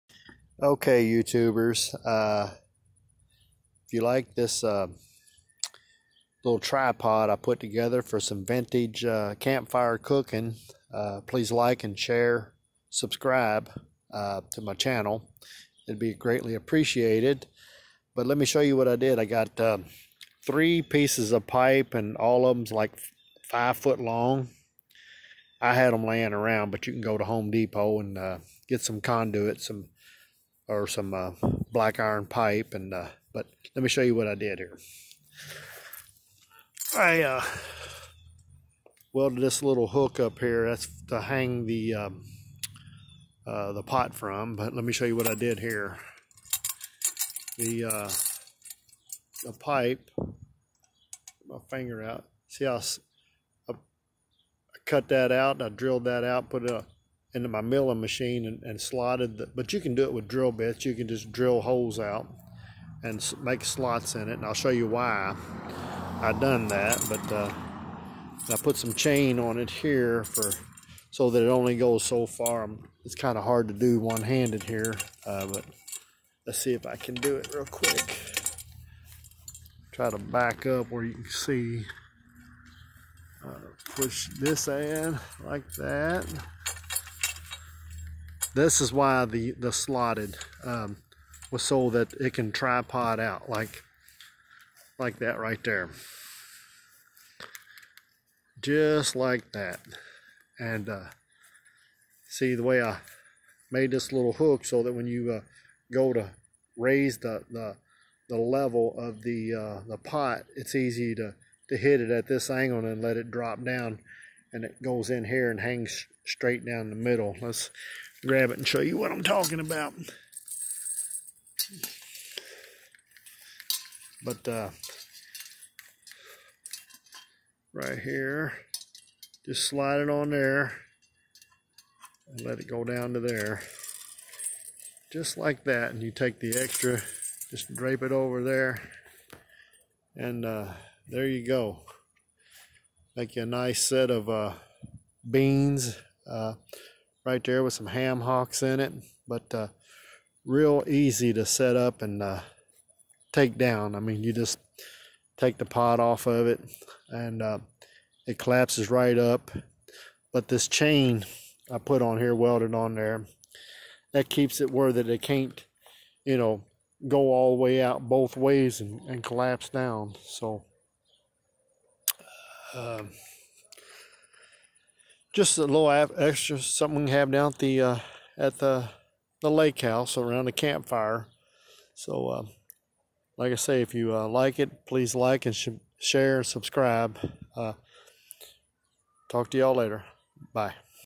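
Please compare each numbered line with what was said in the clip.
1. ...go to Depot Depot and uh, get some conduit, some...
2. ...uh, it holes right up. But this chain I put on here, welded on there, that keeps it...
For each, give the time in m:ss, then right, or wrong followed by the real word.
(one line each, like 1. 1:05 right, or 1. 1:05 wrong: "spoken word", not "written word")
1. 0:27 wrong: "Home", not "Depot"
2. 2:37 wrong: "collapses", not "holes".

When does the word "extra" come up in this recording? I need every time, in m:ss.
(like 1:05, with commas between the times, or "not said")
2:16, 2:55.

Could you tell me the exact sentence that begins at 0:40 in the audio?
That's to hang the um, uh, the pot from.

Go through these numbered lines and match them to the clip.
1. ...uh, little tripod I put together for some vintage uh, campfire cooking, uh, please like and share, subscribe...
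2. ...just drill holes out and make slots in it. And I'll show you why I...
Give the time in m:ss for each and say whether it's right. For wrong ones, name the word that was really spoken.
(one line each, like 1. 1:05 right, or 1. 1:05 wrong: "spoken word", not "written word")
1. 0:04 right
2. 1:01 right.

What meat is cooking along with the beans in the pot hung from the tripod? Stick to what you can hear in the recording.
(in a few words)
ham hocks.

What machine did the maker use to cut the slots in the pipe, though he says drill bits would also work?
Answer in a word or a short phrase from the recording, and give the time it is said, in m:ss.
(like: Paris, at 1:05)
milling machine, at 0:57.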